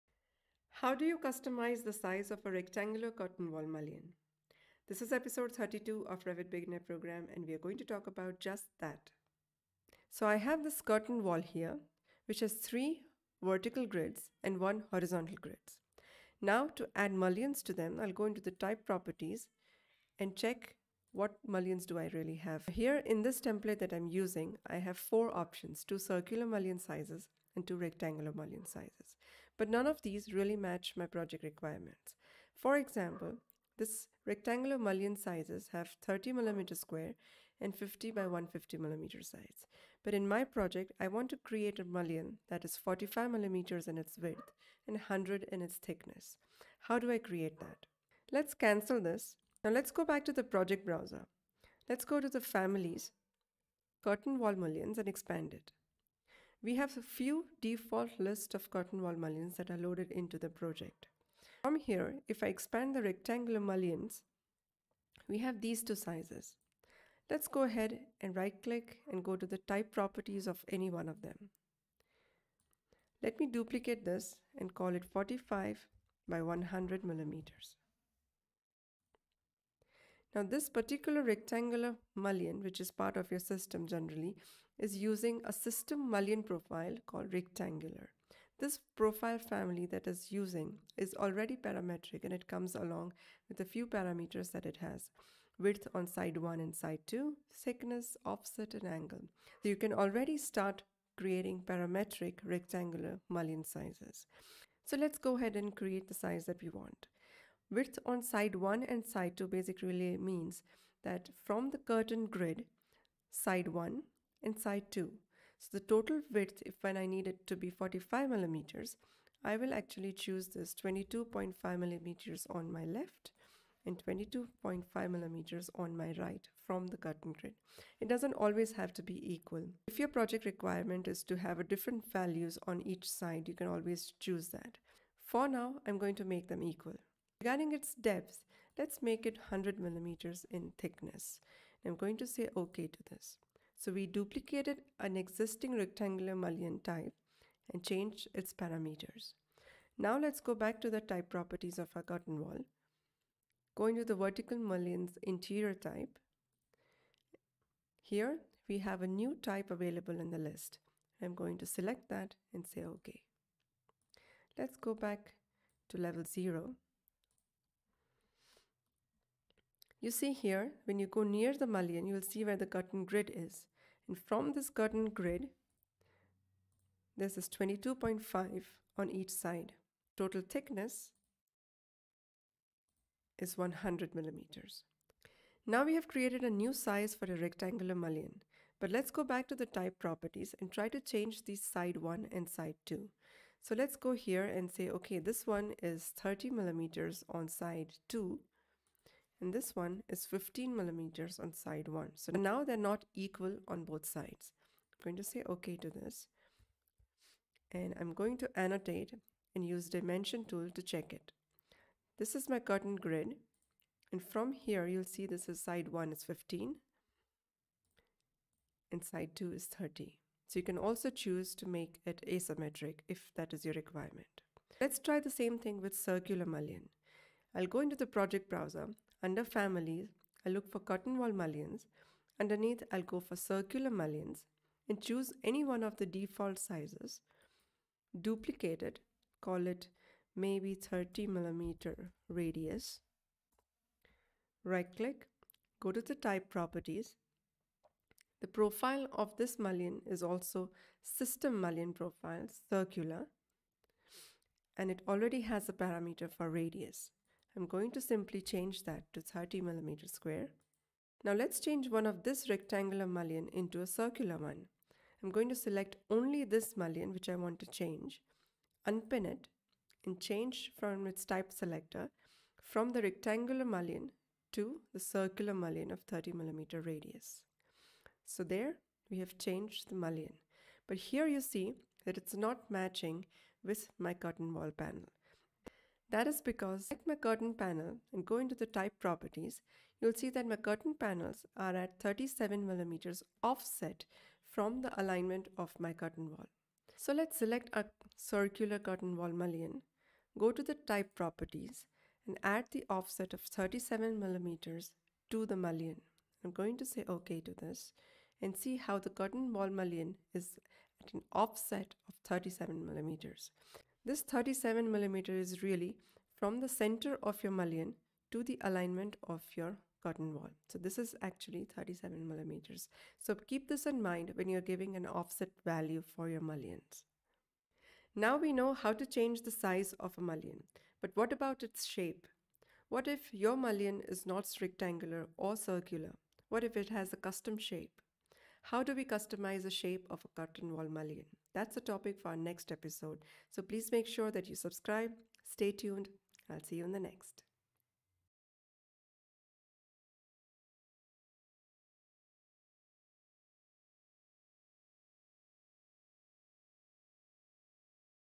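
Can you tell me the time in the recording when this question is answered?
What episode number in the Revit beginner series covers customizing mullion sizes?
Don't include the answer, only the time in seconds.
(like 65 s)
5 s.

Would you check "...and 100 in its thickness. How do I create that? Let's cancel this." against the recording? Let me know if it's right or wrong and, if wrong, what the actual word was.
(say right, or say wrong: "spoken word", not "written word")
right.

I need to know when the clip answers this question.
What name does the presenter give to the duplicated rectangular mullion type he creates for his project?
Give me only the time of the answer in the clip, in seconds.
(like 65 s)
75 s.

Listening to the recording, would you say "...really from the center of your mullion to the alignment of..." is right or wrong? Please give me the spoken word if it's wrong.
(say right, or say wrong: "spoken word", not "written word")
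right.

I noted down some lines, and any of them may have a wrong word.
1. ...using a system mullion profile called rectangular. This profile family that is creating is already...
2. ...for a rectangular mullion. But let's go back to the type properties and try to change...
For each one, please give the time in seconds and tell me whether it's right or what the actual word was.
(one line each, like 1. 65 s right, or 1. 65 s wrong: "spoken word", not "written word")
1. 84 s wrong: "using", not "creating"
2. 187 s right.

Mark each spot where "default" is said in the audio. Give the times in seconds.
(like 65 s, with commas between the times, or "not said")
57 s, 236 s.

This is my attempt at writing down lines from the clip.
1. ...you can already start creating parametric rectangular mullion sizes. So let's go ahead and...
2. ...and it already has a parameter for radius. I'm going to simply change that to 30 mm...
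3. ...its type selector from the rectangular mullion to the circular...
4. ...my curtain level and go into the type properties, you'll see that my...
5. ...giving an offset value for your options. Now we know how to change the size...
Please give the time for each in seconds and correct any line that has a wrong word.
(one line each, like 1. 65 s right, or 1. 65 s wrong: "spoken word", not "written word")
1. 99 s right
2. 254 s right
3. 271 s right
4. 287 s wrong: "panel", not "level"
5. 324 s wrong: "mullions", not "options".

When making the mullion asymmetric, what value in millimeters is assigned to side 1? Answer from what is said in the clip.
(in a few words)
15.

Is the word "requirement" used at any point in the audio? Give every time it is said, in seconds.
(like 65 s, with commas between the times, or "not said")
31 s, 130 s, 223 s.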